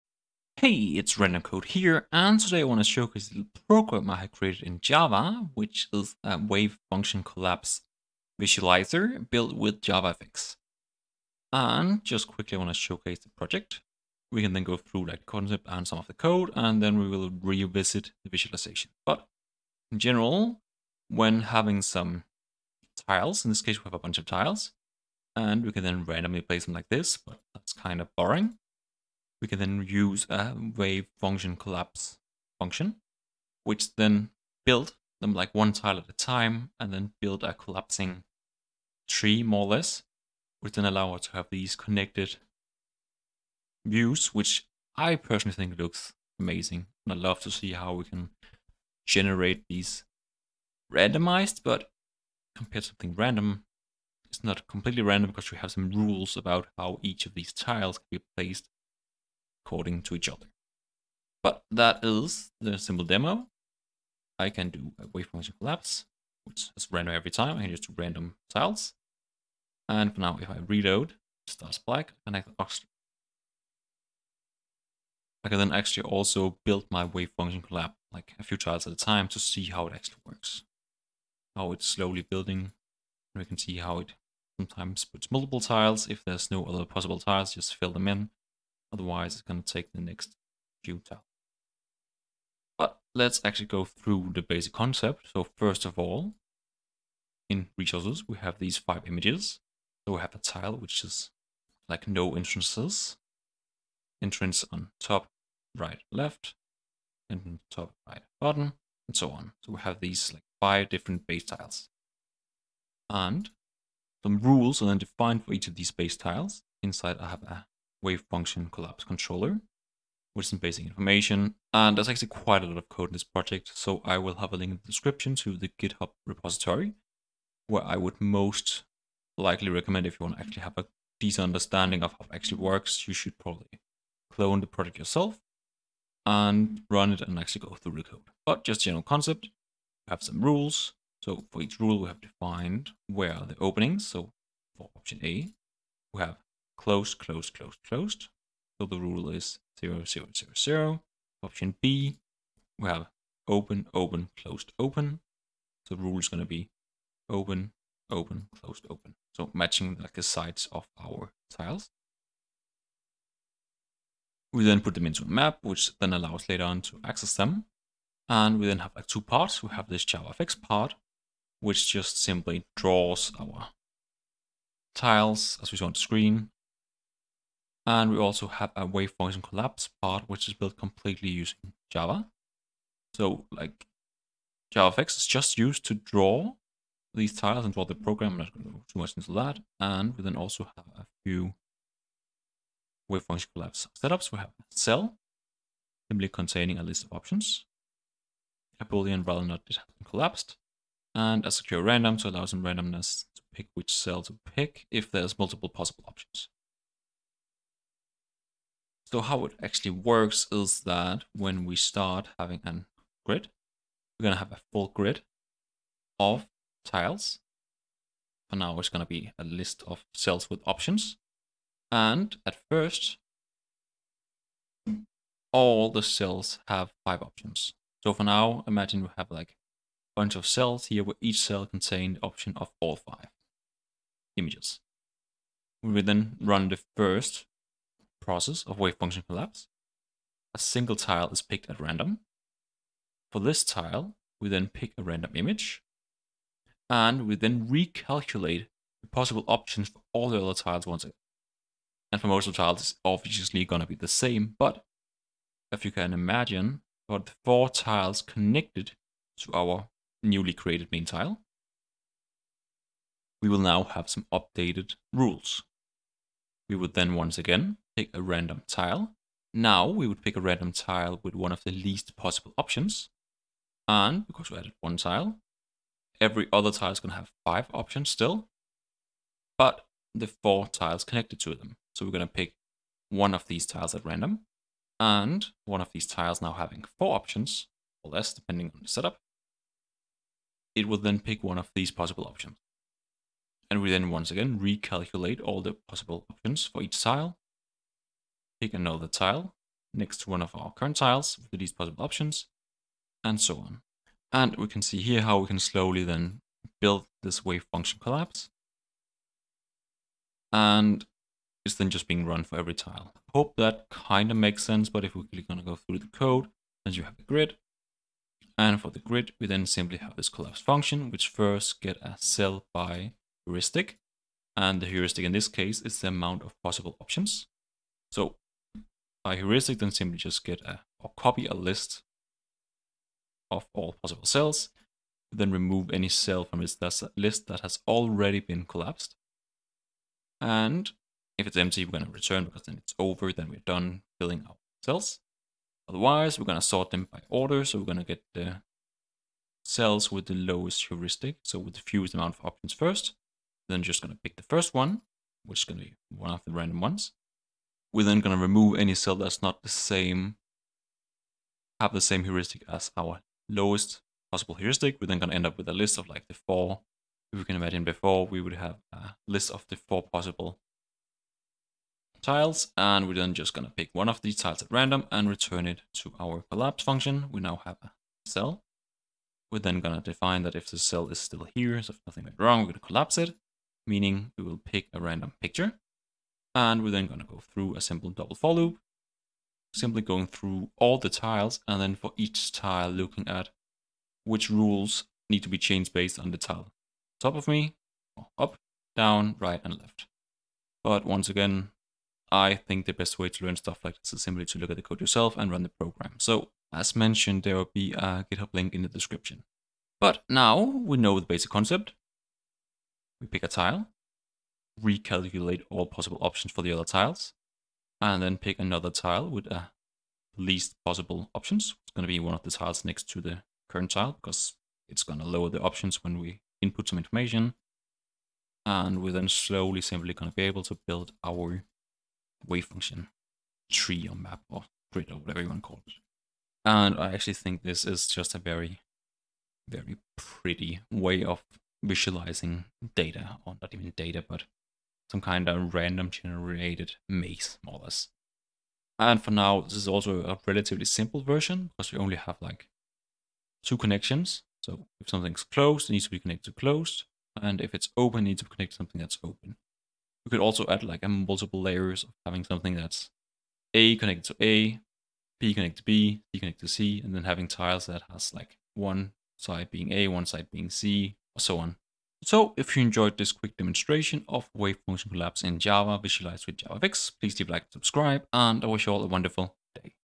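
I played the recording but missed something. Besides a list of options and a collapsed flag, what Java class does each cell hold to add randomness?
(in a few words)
Secure random.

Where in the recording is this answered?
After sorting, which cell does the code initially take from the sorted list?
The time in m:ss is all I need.
5:54.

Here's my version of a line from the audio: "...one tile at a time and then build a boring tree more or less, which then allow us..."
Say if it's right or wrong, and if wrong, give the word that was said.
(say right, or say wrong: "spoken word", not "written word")
wrong: "collapsing", not "boring".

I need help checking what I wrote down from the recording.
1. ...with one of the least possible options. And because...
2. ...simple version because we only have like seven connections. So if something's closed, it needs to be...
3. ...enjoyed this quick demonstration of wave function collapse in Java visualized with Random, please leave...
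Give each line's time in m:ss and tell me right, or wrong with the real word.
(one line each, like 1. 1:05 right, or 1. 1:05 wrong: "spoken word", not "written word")
1. 4:31 right
2. 7:30 wrong: "two", not "seven"
3. 7:52 wrong: "JavaFX", not "Random".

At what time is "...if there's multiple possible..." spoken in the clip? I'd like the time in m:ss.
3:24.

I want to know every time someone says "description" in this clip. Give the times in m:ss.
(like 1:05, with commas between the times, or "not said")
2:04, 6:48.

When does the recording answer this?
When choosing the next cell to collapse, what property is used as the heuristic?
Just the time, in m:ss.
5:25.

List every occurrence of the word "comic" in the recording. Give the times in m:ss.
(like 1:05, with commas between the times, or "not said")
not said.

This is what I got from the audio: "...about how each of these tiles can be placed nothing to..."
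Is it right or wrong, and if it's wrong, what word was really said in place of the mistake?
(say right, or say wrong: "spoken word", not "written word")
wrong: "according", not "nothing".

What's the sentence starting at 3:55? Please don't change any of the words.
We then run the first process of wave function collapse, a single tile is picked at random.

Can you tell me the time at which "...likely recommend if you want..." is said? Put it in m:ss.
2:09.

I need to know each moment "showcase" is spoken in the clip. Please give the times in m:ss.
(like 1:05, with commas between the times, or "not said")
0:02, 0:12.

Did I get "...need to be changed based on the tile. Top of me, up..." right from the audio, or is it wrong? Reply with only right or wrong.
right.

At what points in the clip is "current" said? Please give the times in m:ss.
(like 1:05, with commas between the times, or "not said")
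5:00, 7:03.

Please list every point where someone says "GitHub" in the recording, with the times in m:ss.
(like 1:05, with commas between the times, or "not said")
2:05, 6:48.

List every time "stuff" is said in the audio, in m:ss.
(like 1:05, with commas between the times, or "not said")
6:43.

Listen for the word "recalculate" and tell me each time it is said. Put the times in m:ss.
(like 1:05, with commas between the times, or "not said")
4:07, 4:54, 6:54.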